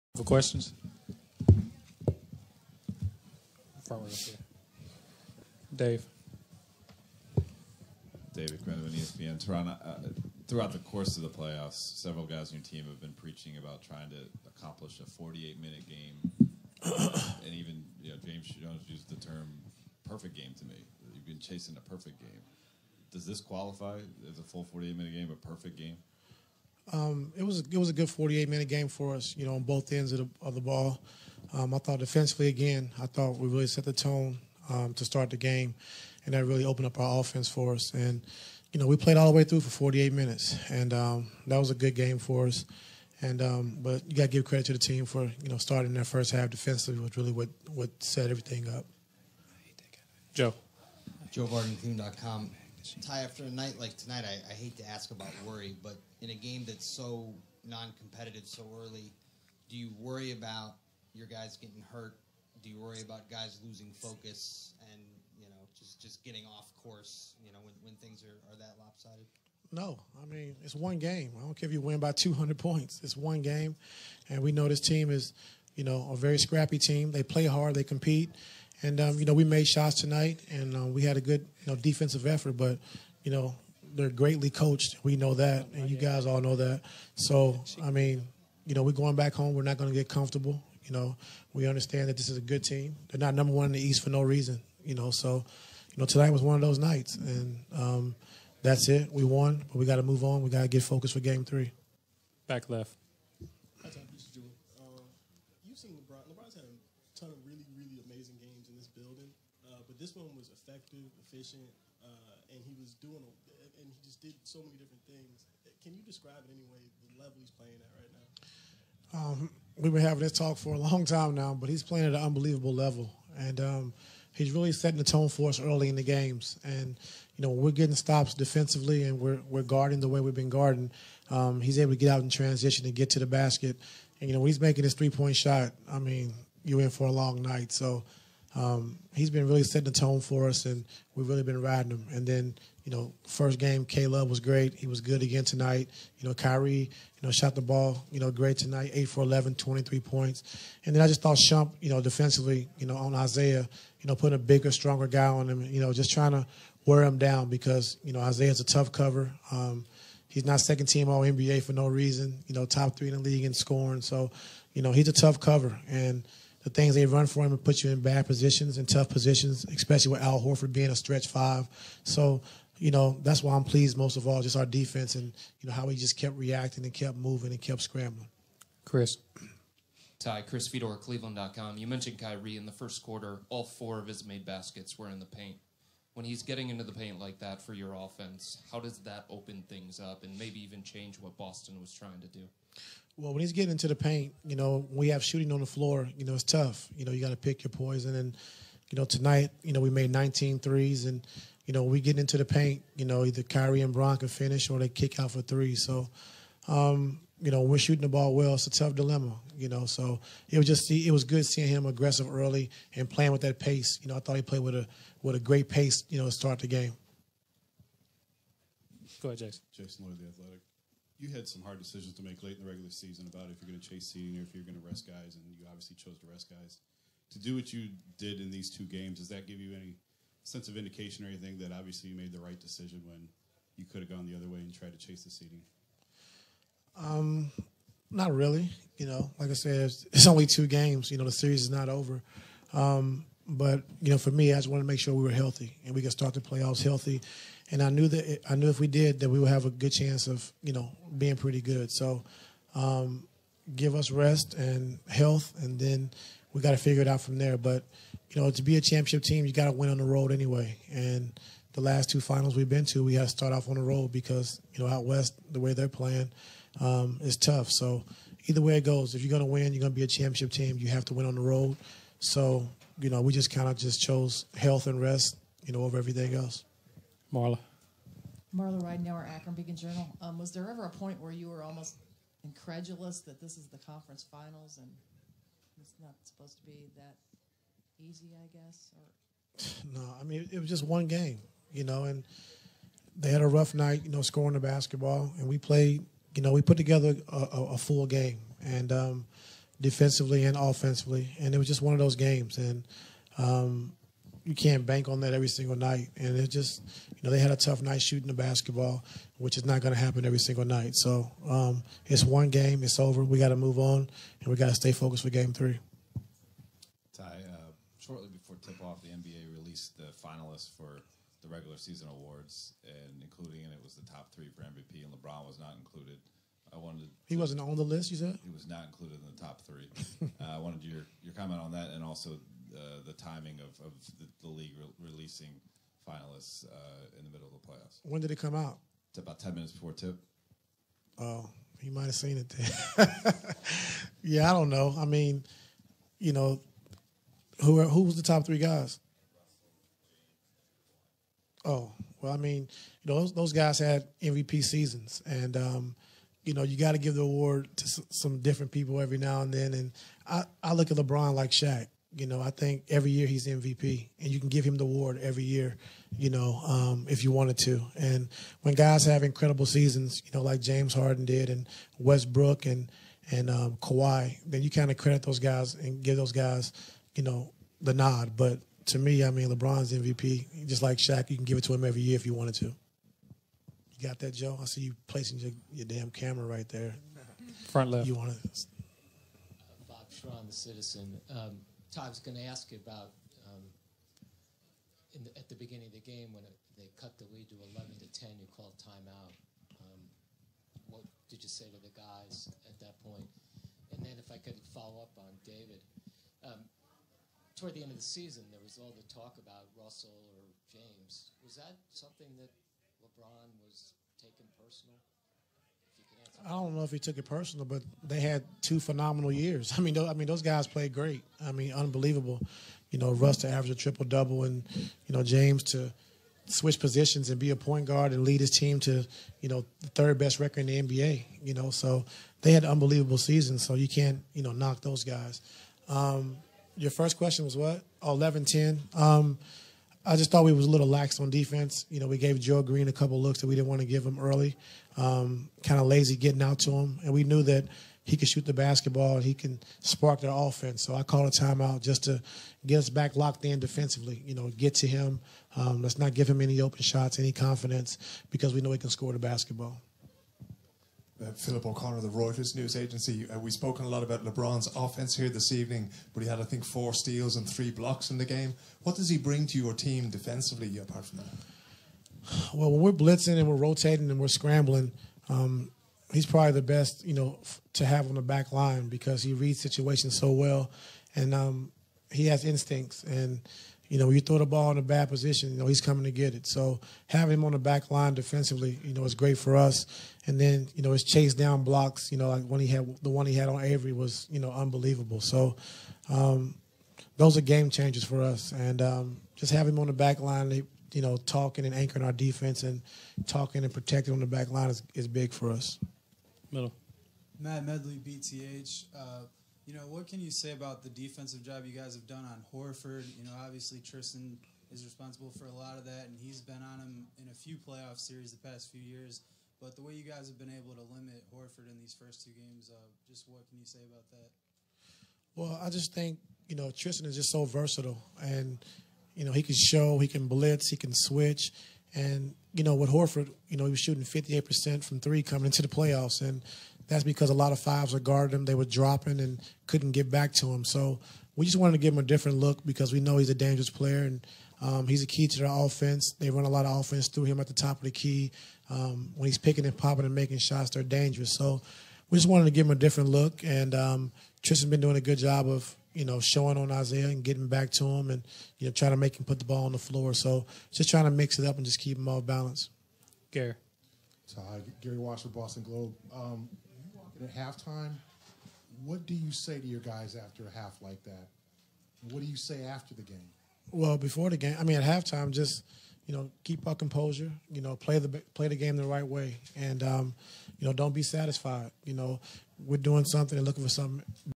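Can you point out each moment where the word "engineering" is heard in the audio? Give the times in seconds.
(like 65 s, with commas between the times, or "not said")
not said.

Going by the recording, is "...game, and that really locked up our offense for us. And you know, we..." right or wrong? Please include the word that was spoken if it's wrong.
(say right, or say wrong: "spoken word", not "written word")
wrong: "opened", not "locked".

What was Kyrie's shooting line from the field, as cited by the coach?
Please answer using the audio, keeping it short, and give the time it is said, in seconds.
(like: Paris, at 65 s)
8 for 11, at 148 s.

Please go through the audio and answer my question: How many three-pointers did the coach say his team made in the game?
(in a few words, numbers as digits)
19.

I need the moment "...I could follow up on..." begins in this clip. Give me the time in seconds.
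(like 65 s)
404 s.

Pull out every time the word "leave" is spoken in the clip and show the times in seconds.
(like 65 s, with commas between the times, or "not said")
not said.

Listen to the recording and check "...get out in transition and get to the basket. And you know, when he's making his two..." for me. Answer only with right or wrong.
wrong.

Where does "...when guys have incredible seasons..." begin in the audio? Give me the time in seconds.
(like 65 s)
368 s.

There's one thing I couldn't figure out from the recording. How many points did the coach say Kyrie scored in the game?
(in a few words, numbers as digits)
23.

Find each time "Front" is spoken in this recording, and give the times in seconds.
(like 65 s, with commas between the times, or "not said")
387 s.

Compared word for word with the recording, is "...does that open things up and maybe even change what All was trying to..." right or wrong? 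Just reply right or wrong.
wrong.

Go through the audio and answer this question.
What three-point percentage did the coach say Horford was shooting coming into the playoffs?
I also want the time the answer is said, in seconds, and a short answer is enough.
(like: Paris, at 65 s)
58%, at 534 s.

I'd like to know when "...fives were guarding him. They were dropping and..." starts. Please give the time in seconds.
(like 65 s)
537 s.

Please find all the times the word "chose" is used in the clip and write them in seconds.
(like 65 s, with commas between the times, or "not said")
225 s, 273 s.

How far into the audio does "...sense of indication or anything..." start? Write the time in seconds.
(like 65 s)
230 s.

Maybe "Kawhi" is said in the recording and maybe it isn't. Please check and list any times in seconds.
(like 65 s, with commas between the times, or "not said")
373 s.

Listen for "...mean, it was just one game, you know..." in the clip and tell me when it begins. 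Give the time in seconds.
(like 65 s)
290 s.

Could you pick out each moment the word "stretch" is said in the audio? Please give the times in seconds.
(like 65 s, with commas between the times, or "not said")
170 s.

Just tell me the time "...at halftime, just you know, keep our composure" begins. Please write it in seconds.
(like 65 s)
574 s.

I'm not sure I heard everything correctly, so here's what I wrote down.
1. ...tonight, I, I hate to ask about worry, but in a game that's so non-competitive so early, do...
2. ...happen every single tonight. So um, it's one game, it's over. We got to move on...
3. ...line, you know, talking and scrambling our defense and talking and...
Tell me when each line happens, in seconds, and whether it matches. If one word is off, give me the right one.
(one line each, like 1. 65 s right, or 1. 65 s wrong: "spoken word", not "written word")
1. 53 s right
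2. 309 s wrong: "night", not "tonight"
3. 500 s wrong: "anchoring", not "scrambling".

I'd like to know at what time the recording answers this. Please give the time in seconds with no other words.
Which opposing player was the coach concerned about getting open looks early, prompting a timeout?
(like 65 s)
442 s.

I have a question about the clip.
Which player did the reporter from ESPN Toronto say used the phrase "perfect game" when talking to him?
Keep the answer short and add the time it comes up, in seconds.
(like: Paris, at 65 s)
James Jones, at 18 s.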